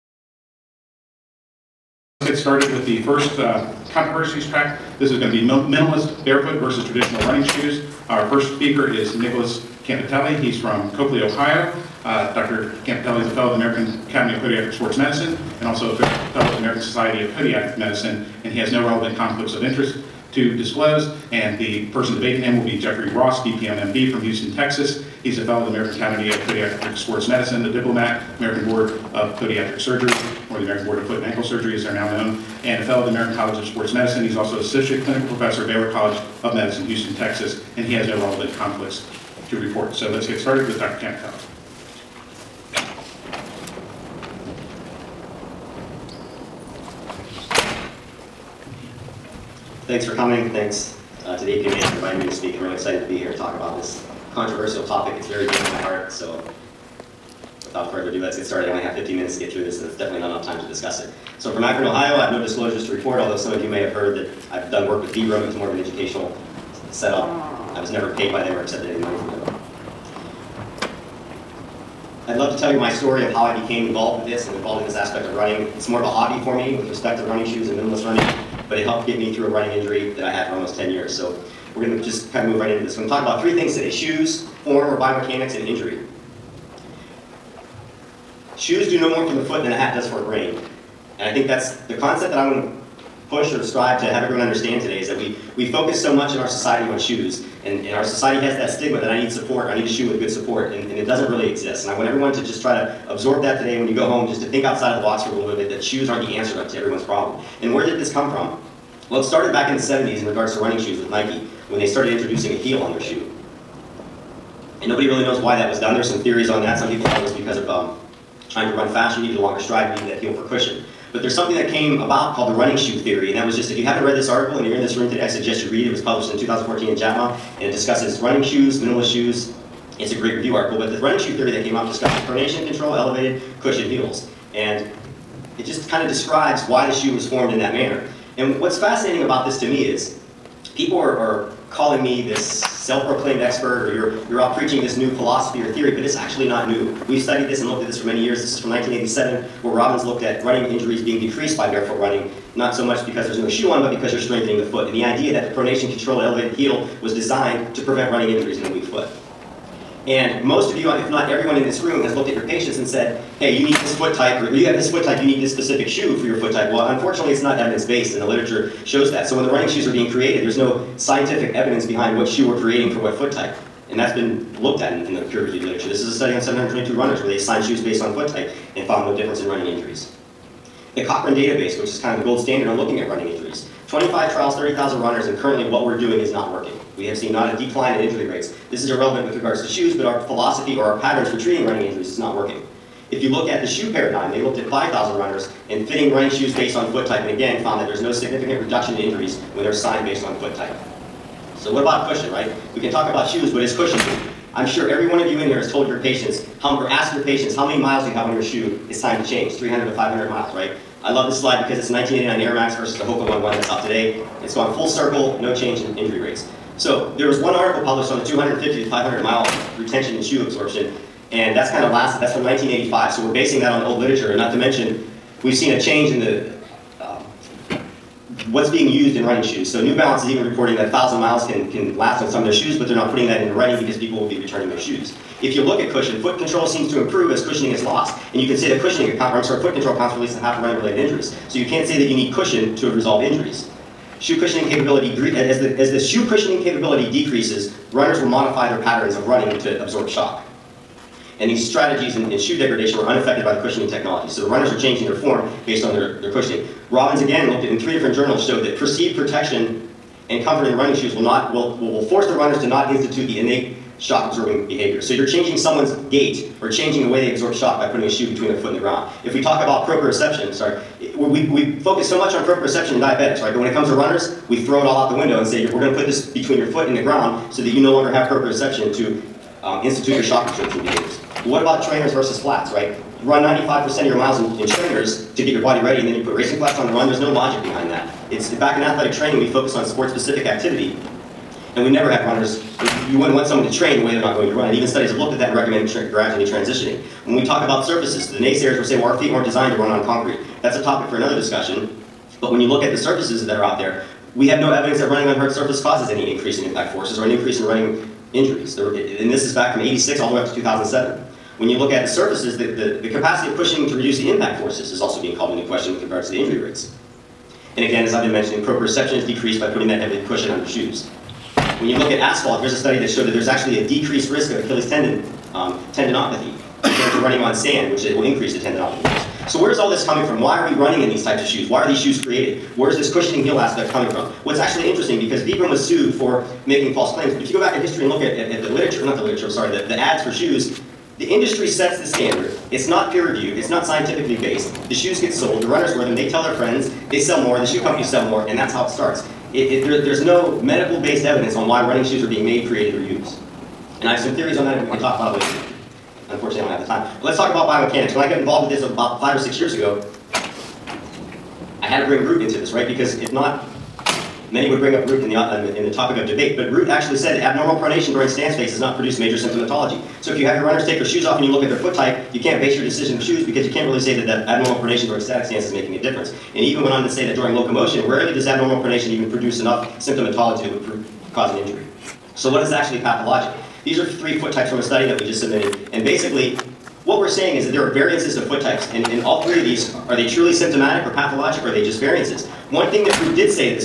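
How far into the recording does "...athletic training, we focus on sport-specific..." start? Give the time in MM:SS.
04:48.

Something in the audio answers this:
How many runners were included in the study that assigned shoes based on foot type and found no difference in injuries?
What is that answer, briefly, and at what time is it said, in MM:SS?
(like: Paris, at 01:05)
722, at 02:56.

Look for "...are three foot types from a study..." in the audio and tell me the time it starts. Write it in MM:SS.
06:23.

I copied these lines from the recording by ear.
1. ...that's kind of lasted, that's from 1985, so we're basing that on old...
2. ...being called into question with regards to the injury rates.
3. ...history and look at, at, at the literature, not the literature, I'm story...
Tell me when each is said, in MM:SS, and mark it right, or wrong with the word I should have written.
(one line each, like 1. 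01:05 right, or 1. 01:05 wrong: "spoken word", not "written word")
1. 03:41 right
2. 05:15 right
3. 05:37 wrong: "sorry", not "story".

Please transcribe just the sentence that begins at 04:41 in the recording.
What about trainers versus flats, right?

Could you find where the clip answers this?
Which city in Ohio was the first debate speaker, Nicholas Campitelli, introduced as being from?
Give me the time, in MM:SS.
00:10.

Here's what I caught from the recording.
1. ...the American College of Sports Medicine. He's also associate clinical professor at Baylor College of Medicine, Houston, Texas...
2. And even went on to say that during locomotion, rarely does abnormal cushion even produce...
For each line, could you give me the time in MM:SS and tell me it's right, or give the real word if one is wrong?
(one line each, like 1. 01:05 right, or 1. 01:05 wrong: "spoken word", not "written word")
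1. 00:33 right
2. 06:16 wrong: "pronation", not "cushion".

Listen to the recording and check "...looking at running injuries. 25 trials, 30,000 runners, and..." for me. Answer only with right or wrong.
right.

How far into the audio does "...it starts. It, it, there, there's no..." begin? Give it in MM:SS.
05:48.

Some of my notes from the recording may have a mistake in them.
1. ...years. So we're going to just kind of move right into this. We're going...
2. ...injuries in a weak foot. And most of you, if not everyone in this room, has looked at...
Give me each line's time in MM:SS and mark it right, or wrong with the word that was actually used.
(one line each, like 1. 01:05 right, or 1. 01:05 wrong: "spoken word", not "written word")
1. 01:20 right
2. 02:38 right.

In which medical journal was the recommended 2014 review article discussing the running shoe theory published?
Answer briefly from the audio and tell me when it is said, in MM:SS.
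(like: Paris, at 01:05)
JAMA, at 02:06.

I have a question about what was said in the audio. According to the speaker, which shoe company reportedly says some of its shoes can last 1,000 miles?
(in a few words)
New Balance.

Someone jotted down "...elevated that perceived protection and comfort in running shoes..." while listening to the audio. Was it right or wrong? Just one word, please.
wrong.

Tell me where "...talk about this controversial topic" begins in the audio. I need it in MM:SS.
00:53.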